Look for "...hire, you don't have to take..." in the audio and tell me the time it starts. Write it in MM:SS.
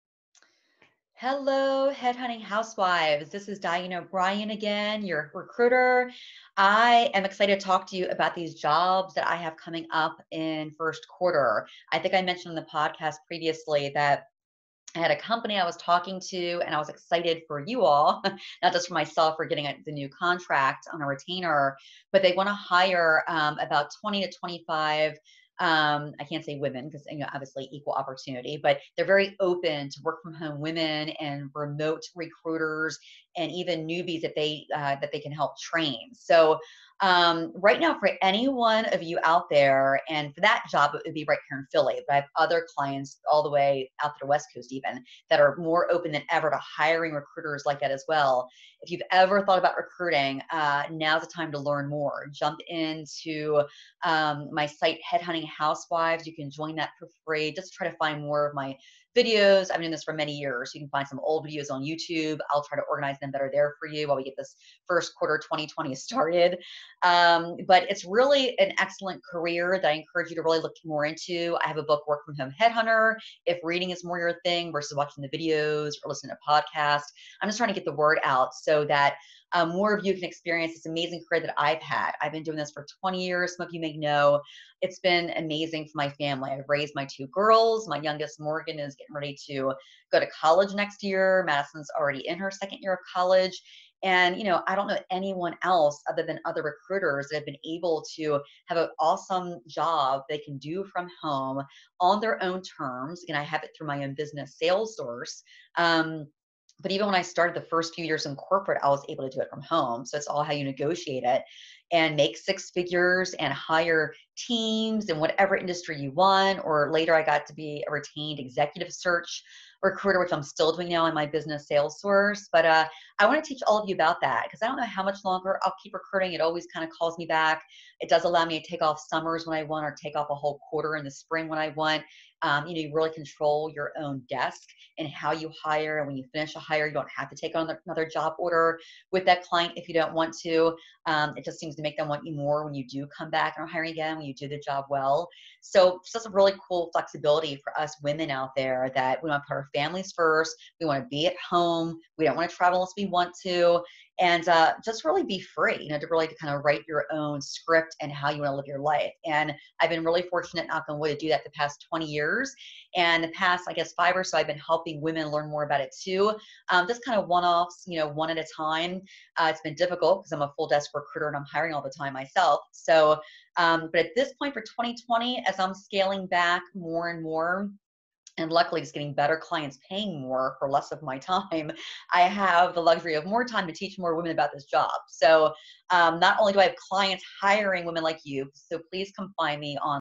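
02:16.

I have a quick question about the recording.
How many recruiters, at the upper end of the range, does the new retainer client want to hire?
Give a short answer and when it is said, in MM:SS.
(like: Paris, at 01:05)
25, at 00:24.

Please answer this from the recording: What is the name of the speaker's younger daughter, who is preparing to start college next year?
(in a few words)
Morgan.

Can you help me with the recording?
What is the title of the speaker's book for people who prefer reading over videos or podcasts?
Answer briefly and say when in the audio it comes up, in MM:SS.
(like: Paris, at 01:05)
Work From Home Headhunter, at 01:12.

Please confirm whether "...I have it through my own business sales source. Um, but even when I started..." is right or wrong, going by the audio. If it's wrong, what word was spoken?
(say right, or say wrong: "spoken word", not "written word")
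right.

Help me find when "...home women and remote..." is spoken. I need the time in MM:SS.
00:30.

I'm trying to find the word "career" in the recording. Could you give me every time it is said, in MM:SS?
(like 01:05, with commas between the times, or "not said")
01:09, 01:21.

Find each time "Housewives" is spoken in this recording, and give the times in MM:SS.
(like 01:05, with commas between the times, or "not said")
00:02, 00:55.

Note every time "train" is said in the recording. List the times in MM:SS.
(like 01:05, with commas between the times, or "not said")
00:35.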